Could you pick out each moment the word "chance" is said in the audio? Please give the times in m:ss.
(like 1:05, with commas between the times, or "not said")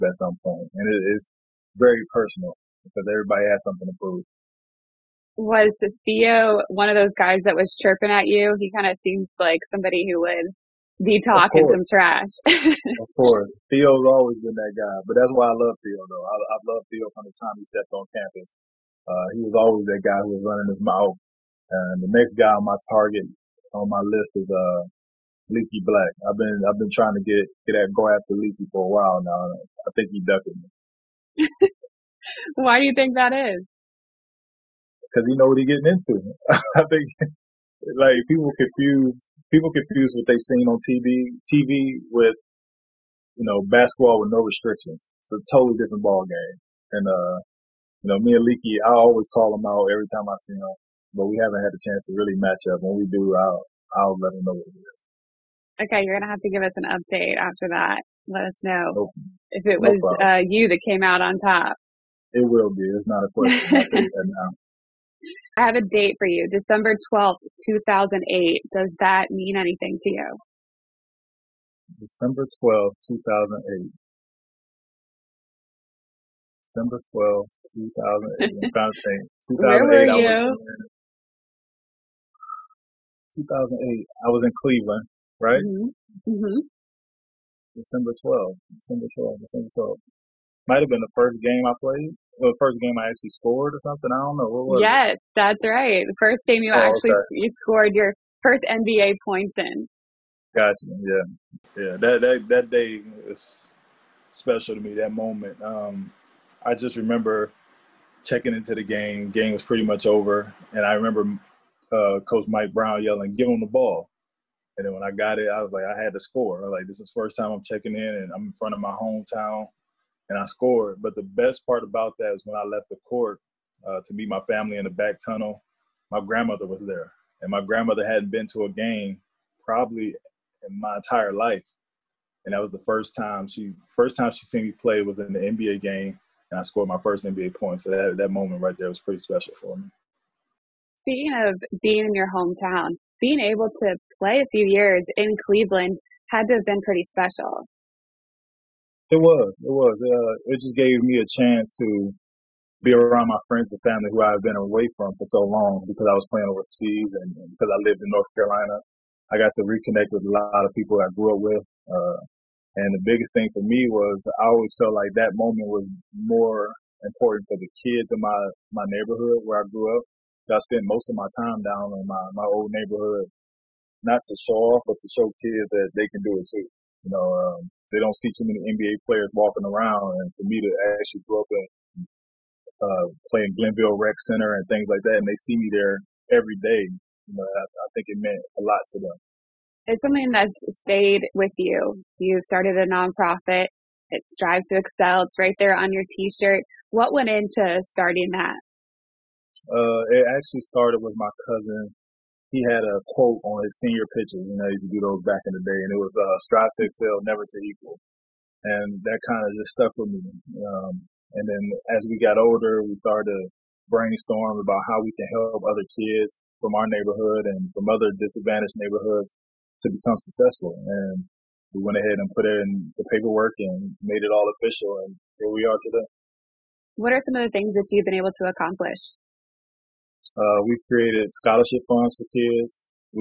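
0:51, 2:31.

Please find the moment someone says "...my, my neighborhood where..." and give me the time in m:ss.
2:48.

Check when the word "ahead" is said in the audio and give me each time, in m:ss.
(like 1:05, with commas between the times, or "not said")
3:41.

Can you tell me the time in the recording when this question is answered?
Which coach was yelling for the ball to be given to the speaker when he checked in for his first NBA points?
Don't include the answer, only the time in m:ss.
1:52.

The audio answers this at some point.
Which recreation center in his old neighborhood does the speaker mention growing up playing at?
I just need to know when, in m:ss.
3:03.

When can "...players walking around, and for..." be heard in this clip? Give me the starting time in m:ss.
2:59.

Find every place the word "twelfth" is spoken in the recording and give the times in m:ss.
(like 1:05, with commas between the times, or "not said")
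1:07, 1:12, 1:17.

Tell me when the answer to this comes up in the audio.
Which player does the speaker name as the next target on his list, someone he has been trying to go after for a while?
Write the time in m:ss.
0:25.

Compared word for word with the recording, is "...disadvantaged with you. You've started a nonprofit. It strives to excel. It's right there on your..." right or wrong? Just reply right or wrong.
wrong.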